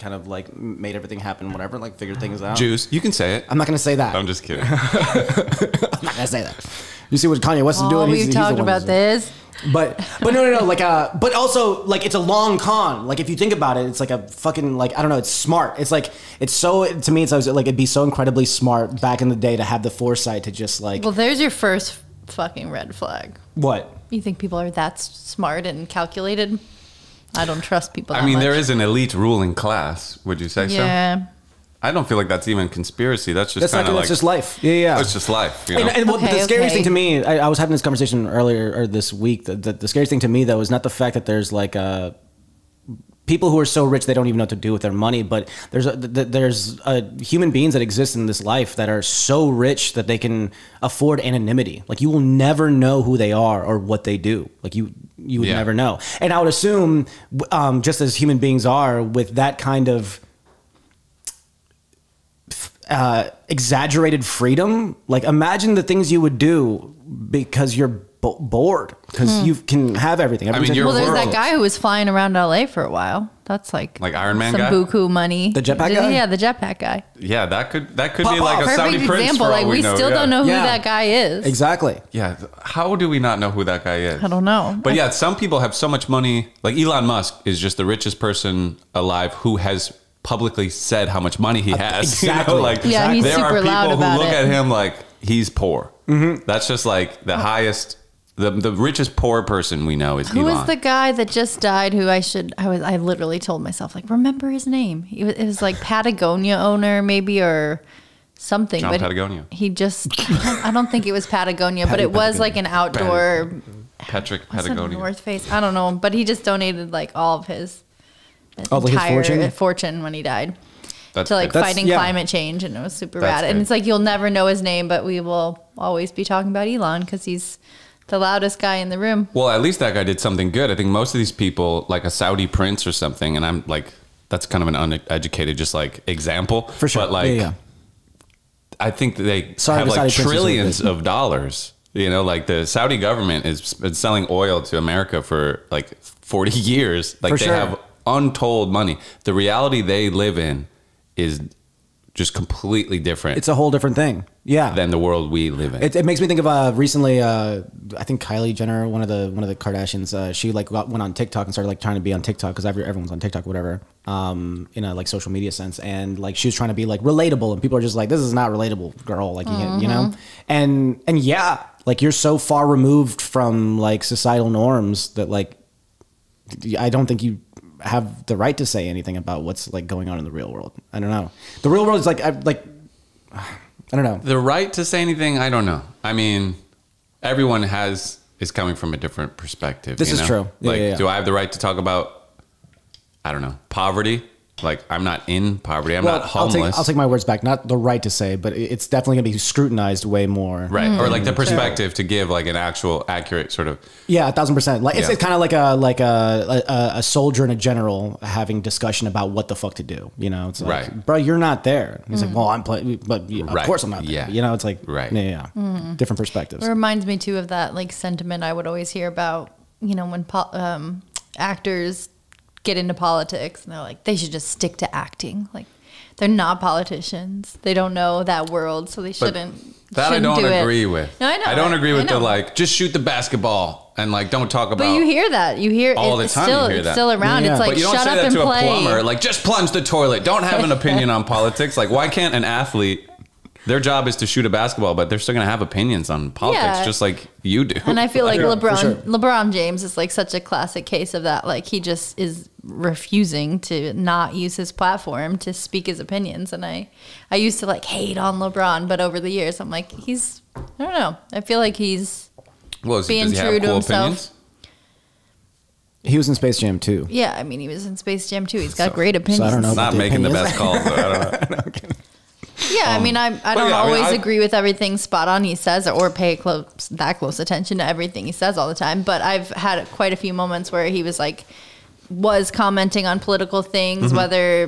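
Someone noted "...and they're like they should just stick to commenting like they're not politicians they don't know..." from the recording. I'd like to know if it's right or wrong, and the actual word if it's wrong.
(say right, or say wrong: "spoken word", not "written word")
wrong: "acting", not "commenting".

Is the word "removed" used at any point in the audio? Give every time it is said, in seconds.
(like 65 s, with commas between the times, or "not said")
172 s.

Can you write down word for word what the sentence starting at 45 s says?
But there's a, there's a human beings that exist in this life that are so rich that they can afford anonymity.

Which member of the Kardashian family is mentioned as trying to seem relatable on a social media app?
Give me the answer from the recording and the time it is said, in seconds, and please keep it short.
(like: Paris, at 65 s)
Kylie Jenner, at 158 s.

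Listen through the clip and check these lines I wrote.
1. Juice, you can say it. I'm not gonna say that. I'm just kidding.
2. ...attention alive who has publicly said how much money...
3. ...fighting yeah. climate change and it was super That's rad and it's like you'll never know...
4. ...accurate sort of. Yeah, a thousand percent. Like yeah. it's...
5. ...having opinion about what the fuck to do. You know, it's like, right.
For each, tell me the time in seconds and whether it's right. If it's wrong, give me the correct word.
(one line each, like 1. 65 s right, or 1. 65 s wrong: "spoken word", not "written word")
1. 2 s right
2. 88 s wrong: "person", not "attention"
3. 121 s right
4. 203 s right
5. 208 s wrong: "discussion", not "opinion".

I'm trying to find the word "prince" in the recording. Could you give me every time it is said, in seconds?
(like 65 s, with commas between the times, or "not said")
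79 s, 132 s.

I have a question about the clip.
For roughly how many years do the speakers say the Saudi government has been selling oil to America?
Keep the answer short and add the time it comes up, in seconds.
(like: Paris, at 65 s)
40, at 146 s.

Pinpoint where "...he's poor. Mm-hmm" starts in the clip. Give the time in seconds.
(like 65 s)
95 s.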